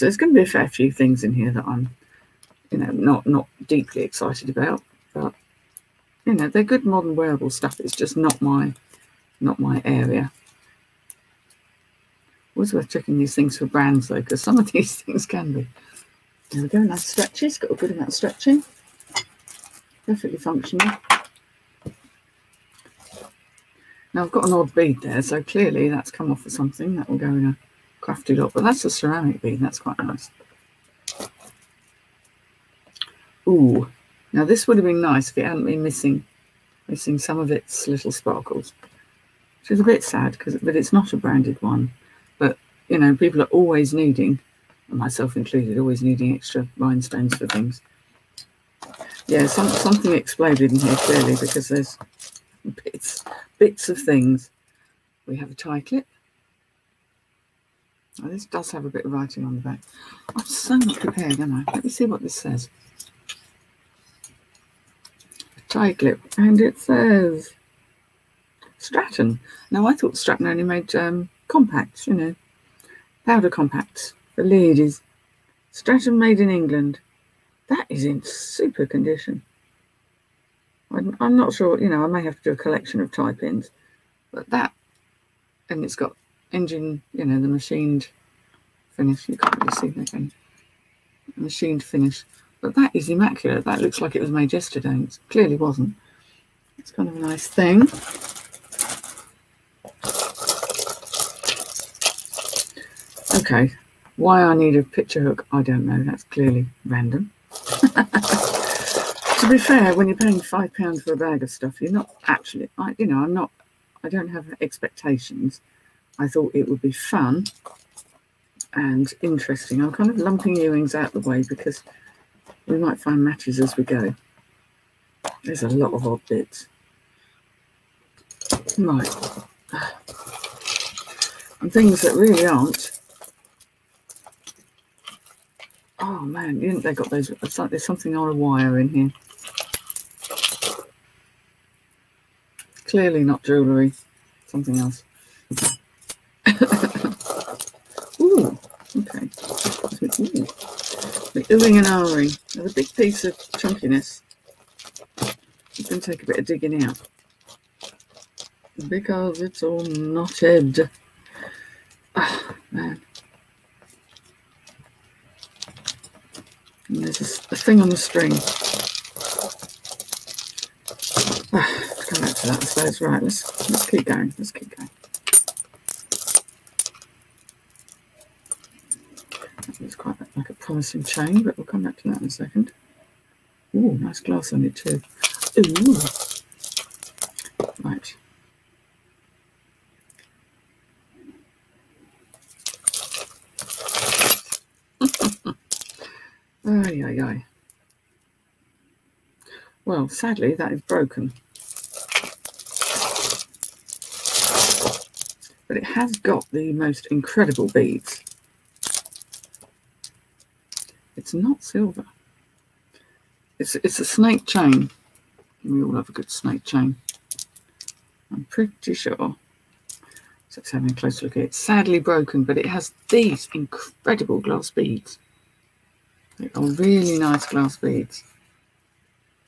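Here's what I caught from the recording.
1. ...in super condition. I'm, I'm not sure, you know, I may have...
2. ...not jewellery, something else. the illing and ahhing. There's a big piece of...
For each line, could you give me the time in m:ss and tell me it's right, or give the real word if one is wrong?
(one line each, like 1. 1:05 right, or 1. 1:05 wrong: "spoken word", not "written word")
1. 1:18 right
2. 2:23 right.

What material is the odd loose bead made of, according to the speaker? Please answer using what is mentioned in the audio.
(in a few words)
ceramic.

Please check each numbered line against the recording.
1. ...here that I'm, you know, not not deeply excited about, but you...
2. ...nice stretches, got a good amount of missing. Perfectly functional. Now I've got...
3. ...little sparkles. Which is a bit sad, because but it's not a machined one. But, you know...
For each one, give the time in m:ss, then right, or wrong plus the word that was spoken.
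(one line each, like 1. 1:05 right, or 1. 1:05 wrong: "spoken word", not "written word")
1. 0:01 right
2. 0:16 wrong: "stretching", not "missing"
3. 0:37 wrong: "branded", not "machined".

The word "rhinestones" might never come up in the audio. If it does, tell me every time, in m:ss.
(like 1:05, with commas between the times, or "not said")
0:46.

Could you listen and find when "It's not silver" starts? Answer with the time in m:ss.
3:31.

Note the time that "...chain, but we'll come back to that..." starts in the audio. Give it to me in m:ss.
3:01.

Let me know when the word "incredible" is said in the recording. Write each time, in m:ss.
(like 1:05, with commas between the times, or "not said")
3:27, 3:43.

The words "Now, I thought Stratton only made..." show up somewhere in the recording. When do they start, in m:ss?
1:09.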